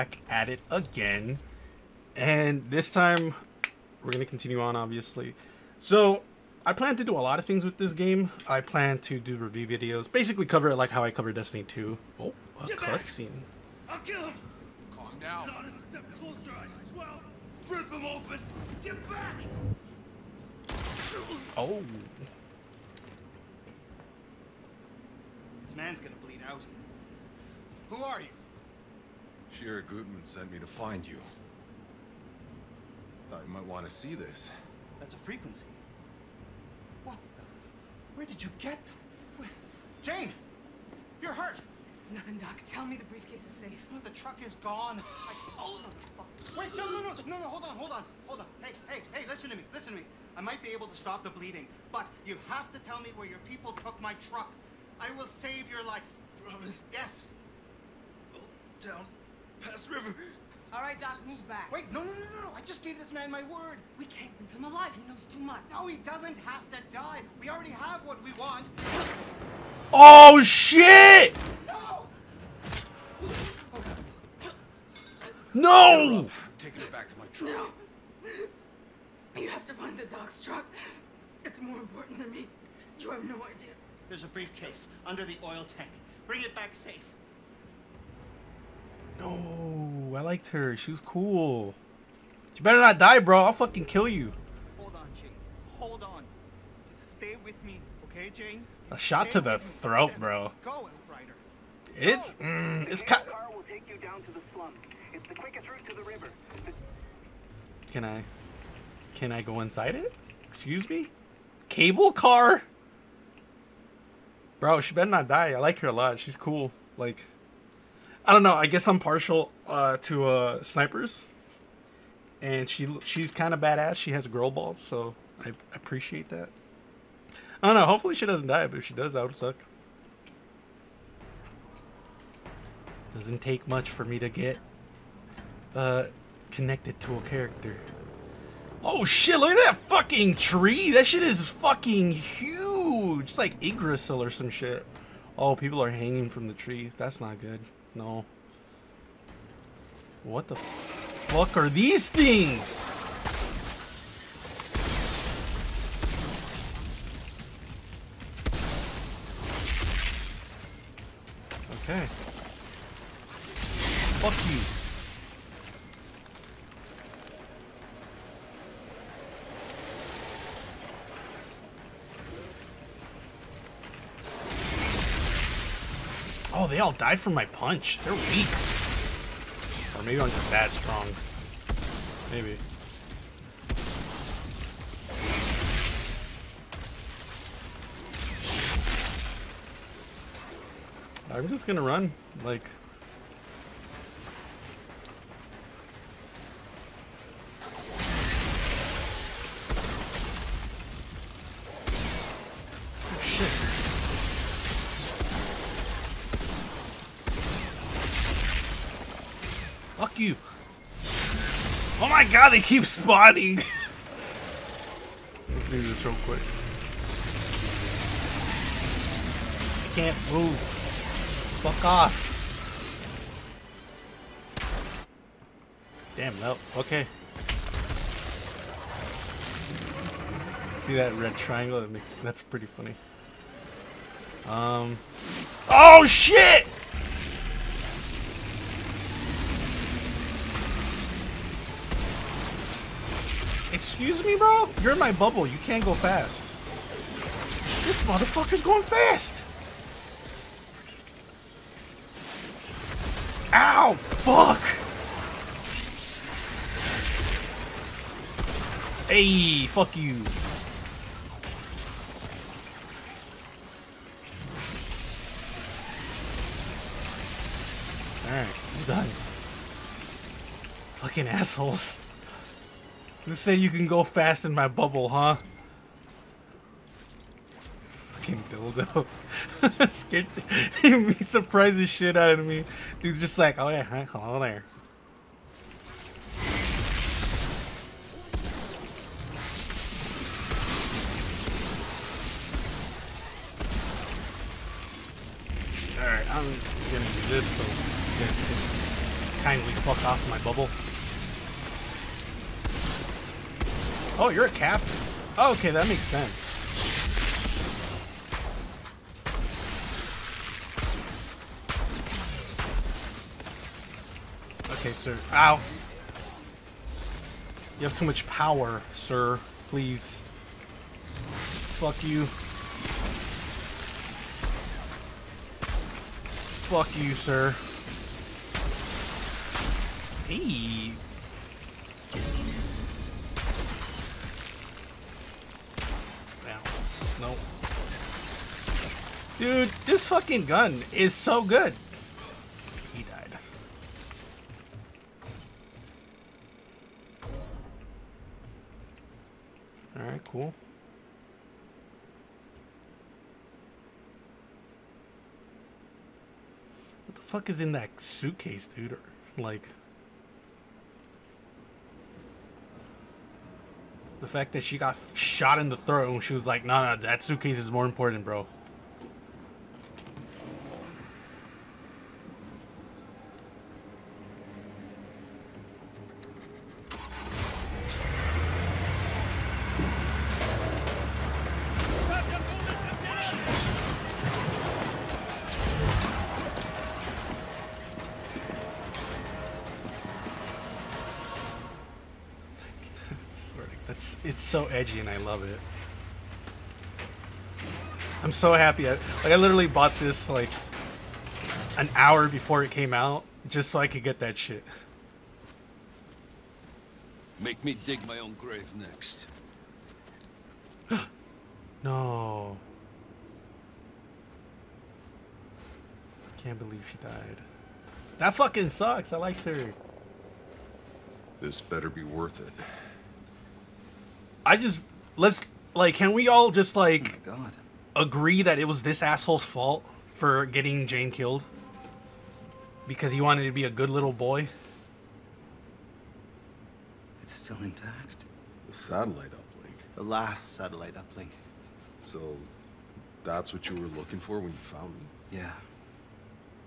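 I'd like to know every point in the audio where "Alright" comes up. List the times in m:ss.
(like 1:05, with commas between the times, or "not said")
4:28, 4:55, 5:49.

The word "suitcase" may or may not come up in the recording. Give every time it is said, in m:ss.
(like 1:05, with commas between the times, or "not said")
5:58, 6:07.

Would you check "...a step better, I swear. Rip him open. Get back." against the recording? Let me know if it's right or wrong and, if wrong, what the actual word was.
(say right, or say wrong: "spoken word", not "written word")
wrong: "closer", not "better".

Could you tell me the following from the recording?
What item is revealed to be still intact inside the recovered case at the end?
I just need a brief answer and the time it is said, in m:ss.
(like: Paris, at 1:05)
The last satellite uplink, at 7:19.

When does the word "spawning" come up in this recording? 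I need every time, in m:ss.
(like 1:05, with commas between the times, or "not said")
3:32.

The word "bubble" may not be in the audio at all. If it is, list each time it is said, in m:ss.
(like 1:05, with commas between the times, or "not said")
4:05, 4:34, 5:00.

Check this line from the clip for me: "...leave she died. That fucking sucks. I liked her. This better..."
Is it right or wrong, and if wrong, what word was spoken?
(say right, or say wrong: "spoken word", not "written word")
wrong: "believe", not "leave".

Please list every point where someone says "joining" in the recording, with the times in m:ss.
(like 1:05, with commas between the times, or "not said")
not said.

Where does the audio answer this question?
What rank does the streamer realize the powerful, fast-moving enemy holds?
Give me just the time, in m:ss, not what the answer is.
5:04.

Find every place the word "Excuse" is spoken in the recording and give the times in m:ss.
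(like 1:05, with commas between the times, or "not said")
1:50, 4:03.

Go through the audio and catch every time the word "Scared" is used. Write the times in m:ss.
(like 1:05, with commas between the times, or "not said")
4:39.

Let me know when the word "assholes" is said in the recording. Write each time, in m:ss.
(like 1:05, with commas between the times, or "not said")
4:31, 7:09.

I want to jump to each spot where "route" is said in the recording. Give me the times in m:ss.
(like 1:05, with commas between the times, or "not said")
1:45.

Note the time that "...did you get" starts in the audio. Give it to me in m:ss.
0:38.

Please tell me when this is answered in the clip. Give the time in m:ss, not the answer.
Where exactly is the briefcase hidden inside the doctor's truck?
1:25.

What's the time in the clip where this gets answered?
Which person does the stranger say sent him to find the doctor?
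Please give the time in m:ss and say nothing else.
0:29.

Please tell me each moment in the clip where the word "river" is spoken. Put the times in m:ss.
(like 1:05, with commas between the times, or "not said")
0:59, 1:46.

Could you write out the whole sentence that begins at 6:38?
I, like I literally bought this like an hour before it came out just so I could get that shit.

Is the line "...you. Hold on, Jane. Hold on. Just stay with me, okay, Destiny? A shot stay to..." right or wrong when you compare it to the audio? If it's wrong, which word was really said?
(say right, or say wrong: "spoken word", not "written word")
wrong: "Jane", not "Destiny".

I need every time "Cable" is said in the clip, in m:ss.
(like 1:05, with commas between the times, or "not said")
1:51.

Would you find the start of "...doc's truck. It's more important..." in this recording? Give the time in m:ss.
1:20.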